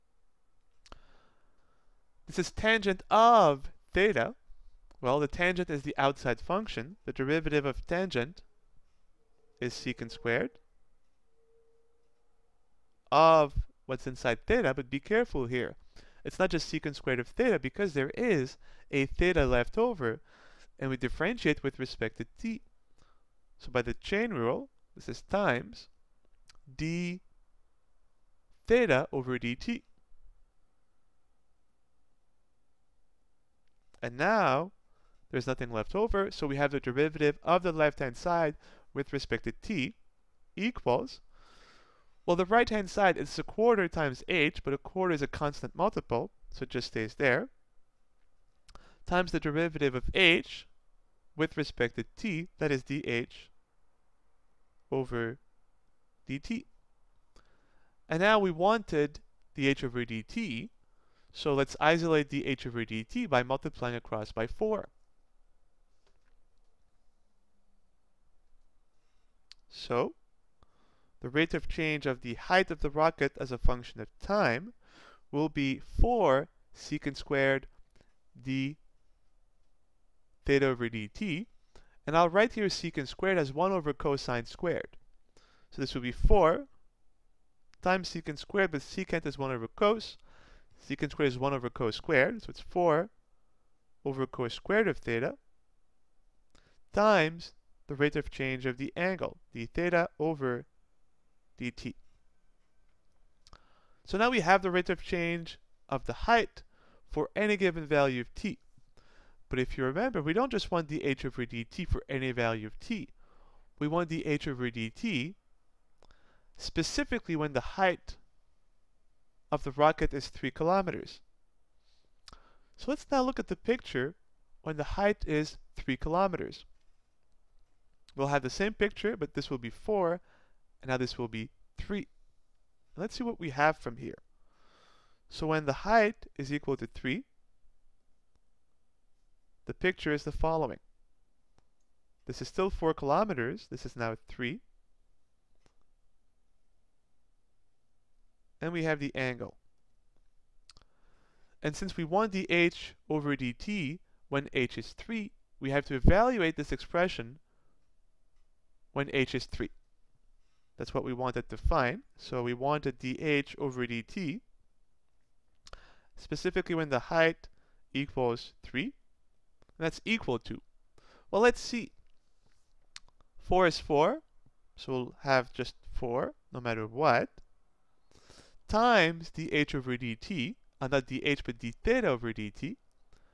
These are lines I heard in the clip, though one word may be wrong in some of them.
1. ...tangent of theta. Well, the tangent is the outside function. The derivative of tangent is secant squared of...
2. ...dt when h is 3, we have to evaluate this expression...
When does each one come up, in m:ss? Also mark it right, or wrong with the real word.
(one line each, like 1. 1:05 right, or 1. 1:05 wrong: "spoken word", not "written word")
1. 0:02 right
2. 2:33 right.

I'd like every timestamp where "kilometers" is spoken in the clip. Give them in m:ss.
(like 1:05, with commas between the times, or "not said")
2:00, 2:05, 2:22.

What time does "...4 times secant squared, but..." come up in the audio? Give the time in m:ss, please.
1:26.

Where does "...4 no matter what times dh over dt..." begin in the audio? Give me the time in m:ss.
2:55.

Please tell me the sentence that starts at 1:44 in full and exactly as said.
So now we have the rate of change of the height for any given value of t.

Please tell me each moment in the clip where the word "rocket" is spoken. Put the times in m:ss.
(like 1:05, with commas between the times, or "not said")
1:12, 1:59.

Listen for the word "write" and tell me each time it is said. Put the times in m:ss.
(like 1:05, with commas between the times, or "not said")
1:22.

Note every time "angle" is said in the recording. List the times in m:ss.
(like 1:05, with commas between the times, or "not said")
1:38, 2:29.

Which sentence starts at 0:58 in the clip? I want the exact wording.
And now we wanted dh over dt so let's isolate dH over dt by multiplying across by 4.